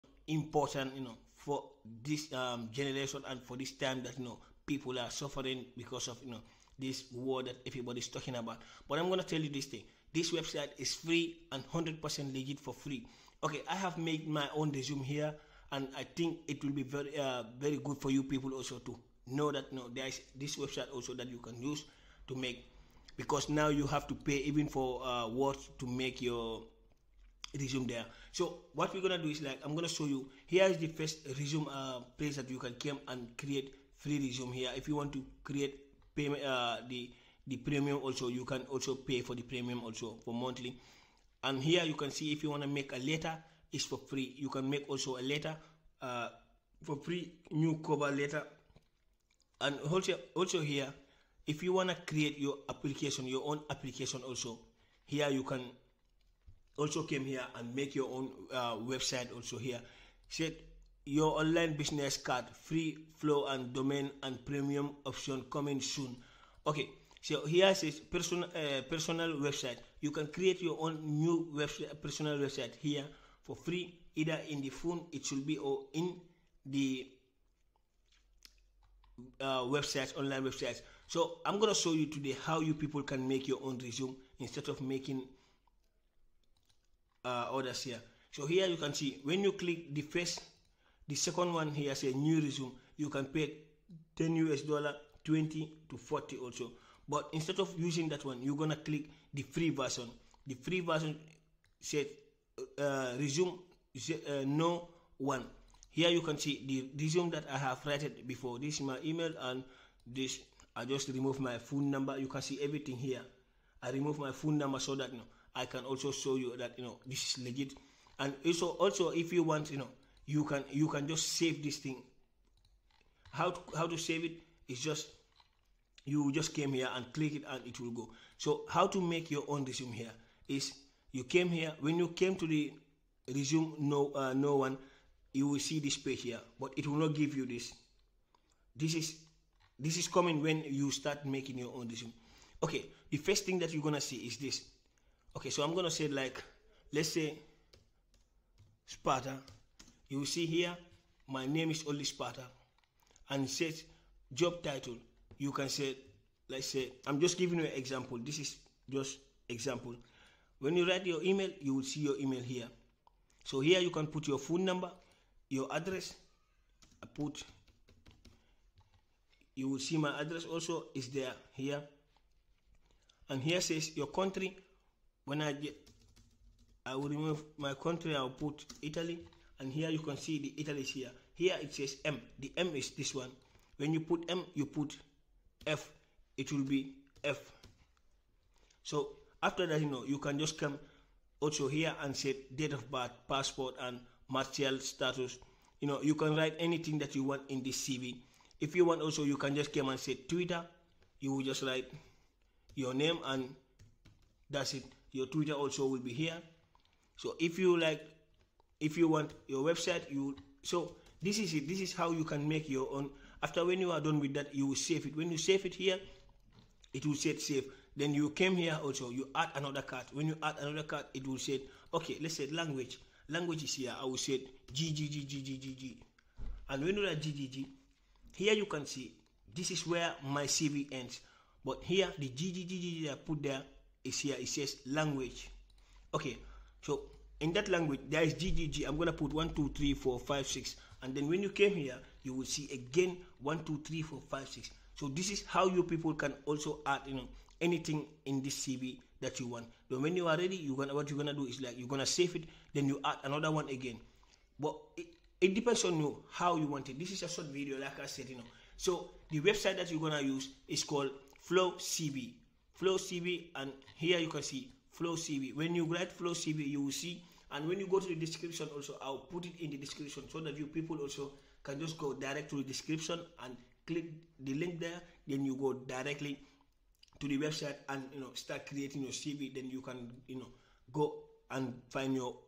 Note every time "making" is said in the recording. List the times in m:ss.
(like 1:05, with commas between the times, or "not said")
1:24, 2:21.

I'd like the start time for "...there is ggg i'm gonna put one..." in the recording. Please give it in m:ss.
3:58.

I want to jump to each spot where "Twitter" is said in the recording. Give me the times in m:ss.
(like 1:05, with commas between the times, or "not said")
3:20, 3:25.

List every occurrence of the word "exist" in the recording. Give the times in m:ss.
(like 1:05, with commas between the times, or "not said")
not said.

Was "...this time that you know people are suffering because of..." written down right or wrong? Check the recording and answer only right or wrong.
right.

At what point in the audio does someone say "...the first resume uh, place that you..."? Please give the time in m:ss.
0:30.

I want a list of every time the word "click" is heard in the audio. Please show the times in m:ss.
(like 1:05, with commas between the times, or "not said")
1:29, 1:38, 2:07, 4:33.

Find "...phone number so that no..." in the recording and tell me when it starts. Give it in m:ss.
1:54.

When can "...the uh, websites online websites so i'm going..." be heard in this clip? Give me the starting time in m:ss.
1:16.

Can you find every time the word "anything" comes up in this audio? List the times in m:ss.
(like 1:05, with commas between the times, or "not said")
3:16, 4:07.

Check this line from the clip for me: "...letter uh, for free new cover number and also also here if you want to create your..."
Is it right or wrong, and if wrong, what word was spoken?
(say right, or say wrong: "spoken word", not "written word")
wrong: "letter", not "number".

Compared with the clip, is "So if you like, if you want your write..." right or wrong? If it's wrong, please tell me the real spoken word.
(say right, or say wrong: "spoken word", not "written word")
wrong: "website", not "write".